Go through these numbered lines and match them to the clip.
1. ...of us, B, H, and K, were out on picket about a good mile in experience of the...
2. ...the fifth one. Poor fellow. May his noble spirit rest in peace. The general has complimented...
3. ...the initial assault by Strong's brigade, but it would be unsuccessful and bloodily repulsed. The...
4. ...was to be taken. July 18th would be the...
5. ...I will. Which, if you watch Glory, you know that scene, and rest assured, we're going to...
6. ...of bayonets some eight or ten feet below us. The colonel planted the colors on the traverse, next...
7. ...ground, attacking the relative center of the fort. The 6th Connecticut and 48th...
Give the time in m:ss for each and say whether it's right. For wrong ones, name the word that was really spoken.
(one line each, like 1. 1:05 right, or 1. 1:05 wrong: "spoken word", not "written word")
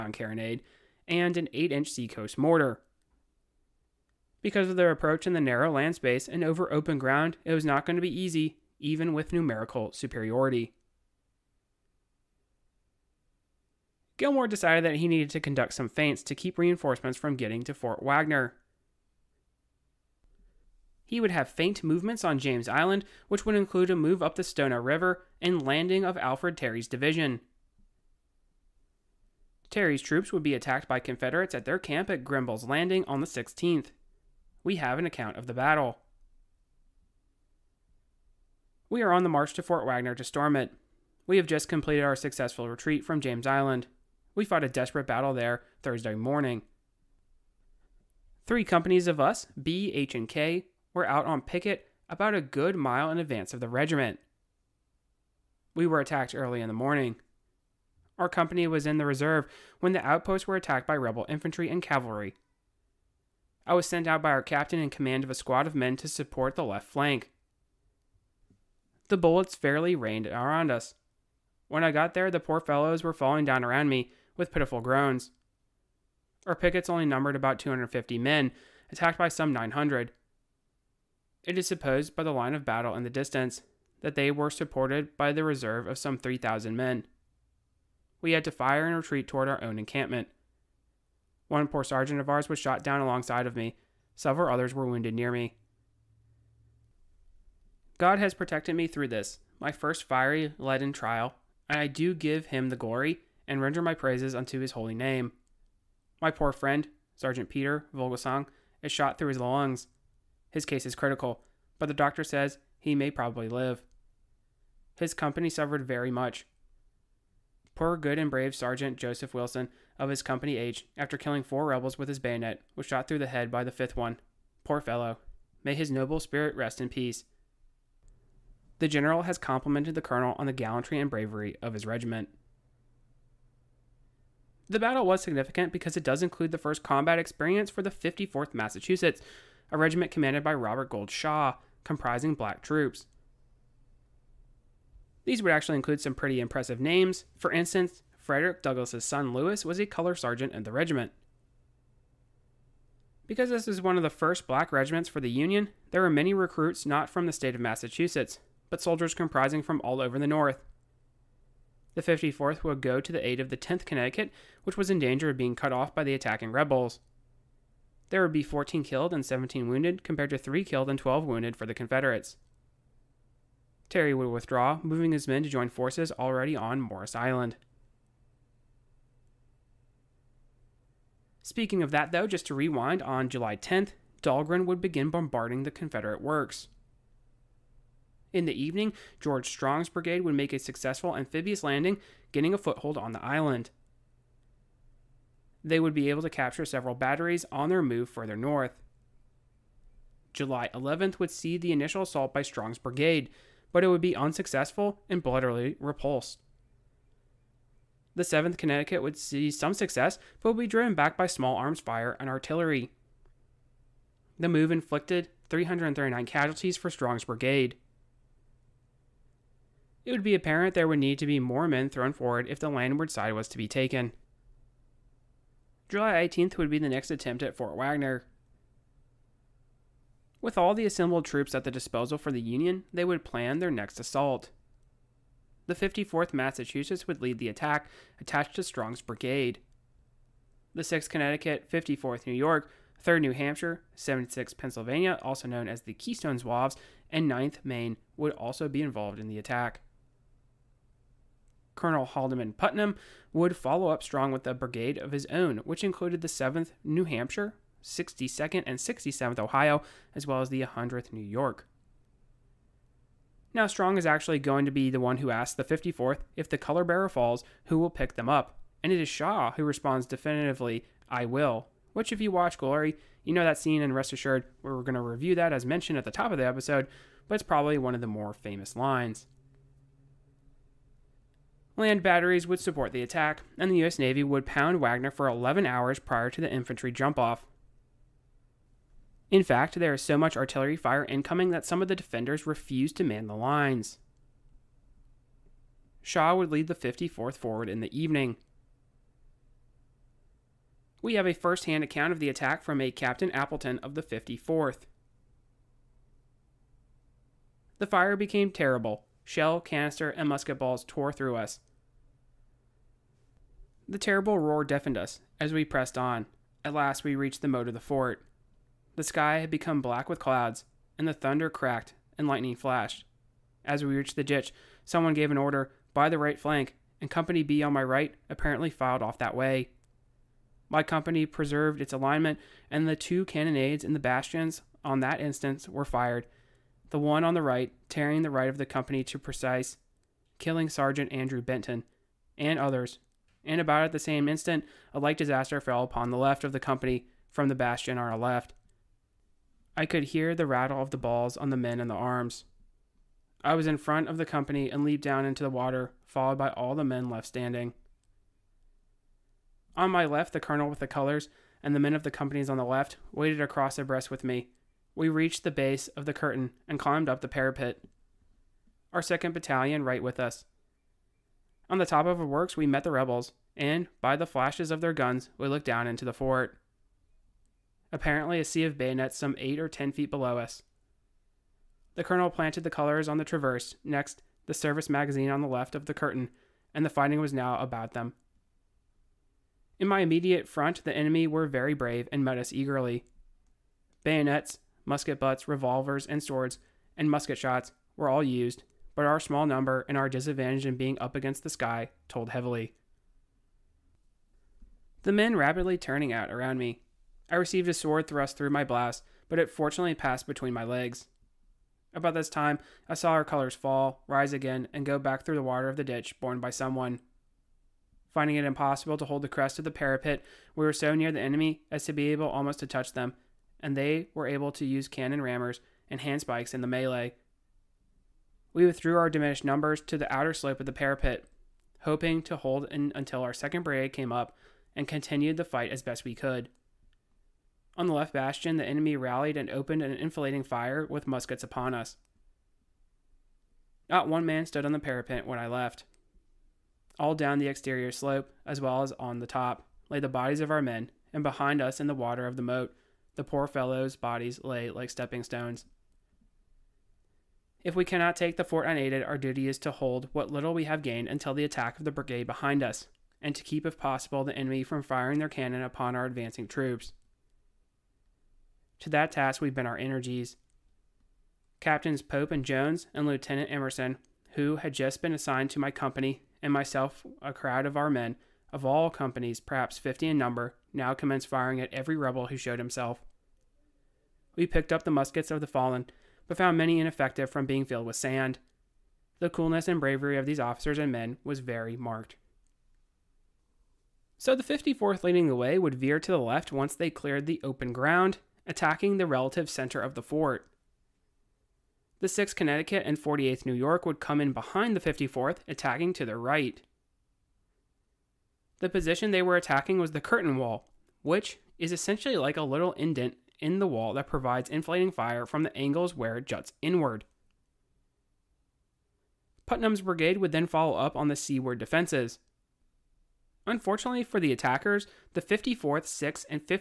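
1. 0:49 wrong: "advance", not "experience"
2. 2:03 right
3. 3:21 right
4. 3:43 right
5. 4:31 right
6. 6:18 right
7. 8:17 right.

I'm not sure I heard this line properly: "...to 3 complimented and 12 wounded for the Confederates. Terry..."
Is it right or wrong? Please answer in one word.
wrong.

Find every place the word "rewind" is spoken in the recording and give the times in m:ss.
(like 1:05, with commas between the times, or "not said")
3:02.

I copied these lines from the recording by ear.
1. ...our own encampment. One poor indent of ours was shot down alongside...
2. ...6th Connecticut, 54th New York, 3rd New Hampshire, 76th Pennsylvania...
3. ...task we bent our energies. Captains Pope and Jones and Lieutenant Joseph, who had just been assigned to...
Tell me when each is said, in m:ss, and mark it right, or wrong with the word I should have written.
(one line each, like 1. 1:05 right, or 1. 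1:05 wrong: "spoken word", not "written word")
1. 1:29 wrong: "sergeant", not "indent"
2. 4:00 right
3. 7:49 wrong: "Emerson", not "Joseph".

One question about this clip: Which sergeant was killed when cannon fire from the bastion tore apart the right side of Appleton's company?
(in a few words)
Andrew Benton.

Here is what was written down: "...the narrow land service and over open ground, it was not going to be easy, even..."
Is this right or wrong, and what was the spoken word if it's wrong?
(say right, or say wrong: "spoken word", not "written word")
wrong: "space", not "service".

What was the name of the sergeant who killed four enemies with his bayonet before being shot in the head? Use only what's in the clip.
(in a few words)
Joseph Wilson.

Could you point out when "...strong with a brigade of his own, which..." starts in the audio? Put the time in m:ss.
4:14.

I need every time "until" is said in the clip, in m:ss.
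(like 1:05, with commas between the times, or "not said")
7:12, 7:41.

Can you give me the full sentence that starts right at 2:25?
These would actually include some pretty impressive names.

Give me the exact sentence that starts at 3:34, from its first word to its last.
The move inflicted 339 casualties for Strong's brigade.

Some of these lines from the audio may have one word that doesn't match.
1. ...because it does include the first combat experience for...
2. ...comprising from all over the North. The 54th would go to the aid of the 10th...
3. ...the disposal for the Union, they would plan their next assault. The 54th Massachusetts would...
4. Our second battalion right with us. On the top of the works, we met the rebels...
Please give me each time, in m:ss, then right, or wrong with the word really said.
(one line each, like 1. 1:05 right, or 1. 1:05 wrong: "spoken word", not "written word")
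1. 2:15 right
2. 2:39 right
3. 3:51 right
4. 6:08 right.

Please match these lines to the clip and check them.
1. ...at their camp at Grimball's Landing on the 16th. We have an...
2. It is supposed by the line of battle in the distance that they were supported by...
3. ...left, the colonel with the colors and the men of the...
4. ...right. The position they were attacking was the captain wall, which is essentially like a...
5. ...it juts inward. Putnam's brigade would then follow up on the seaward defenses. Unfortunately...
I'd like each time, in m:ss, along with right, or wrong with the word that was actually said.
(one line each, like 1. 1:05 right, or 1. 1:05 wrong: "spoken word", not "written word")
1. 0:31 right
2. 1:21 right
3. 6:00 right
4. 8:26 wrong: "curtain", not "captain"
5. 8:36 right.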